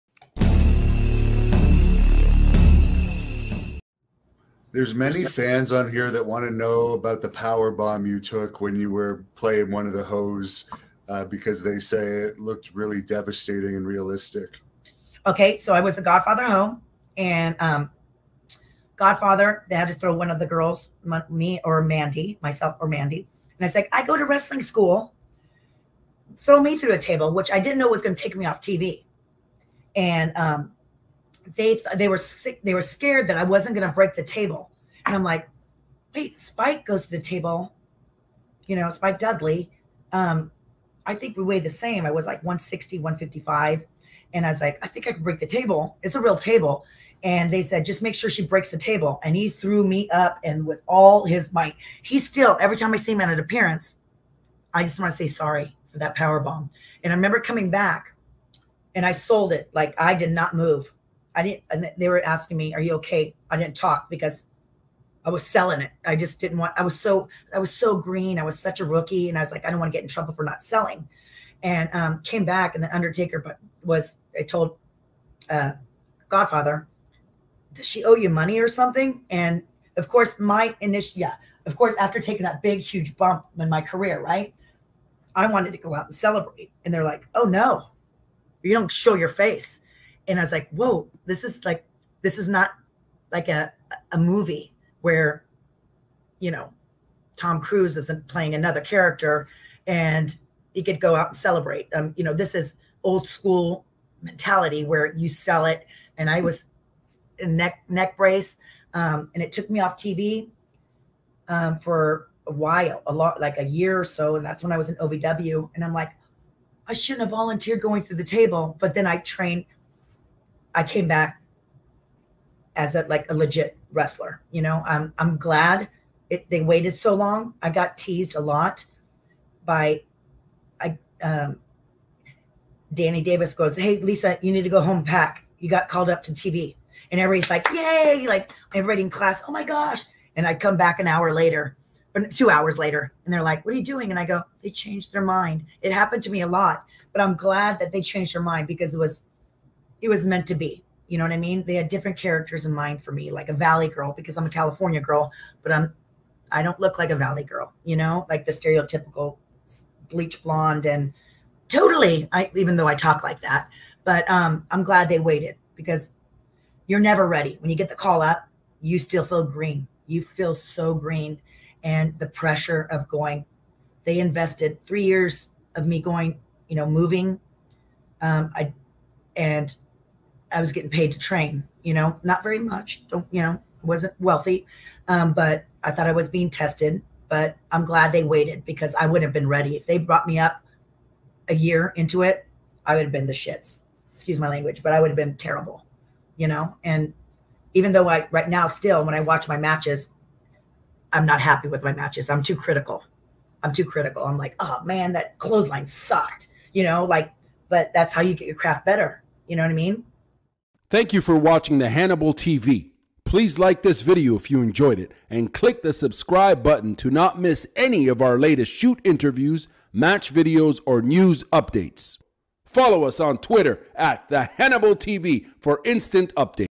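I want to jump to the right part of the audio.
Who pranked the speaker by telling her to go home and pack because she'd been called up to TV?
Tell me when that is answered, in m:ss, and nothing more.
2:12.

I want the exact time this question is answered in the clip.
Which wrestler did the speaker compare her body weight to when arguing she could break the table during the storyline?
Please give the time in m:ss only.
0:38.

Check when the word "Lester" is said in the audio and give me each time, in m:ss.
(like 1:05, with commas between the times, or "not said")
not said.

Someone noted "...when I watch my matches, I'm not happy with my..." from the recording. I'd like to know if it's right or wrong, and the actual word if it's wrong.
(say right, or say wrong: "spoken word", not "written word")
right.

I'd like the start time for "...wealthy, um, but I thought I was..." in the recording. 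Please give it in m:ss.
3:04.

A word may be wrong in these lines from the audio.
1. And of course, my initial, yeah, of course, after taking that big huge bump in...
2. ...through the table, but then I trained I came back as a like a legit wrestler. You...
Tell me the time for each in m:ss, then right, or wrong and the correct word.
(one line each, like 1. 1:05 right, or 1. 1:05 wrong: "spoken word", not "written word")
1. 1:19 right
2. 1:58 right.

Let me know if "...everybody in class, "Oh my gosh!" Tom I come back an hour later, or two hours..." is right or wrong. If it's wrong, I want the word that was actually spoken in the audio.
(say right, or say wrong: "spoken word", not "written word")
wrong: "And", not "Tom".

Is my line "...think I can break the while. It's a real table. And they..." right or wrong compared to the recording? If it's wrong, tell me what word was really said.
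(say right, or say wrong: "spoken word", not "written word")
wrong: "table", not "while".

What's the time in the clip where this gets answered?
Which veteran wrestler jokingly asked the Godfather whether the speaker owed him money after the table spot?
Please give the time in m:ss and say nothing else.
1:12.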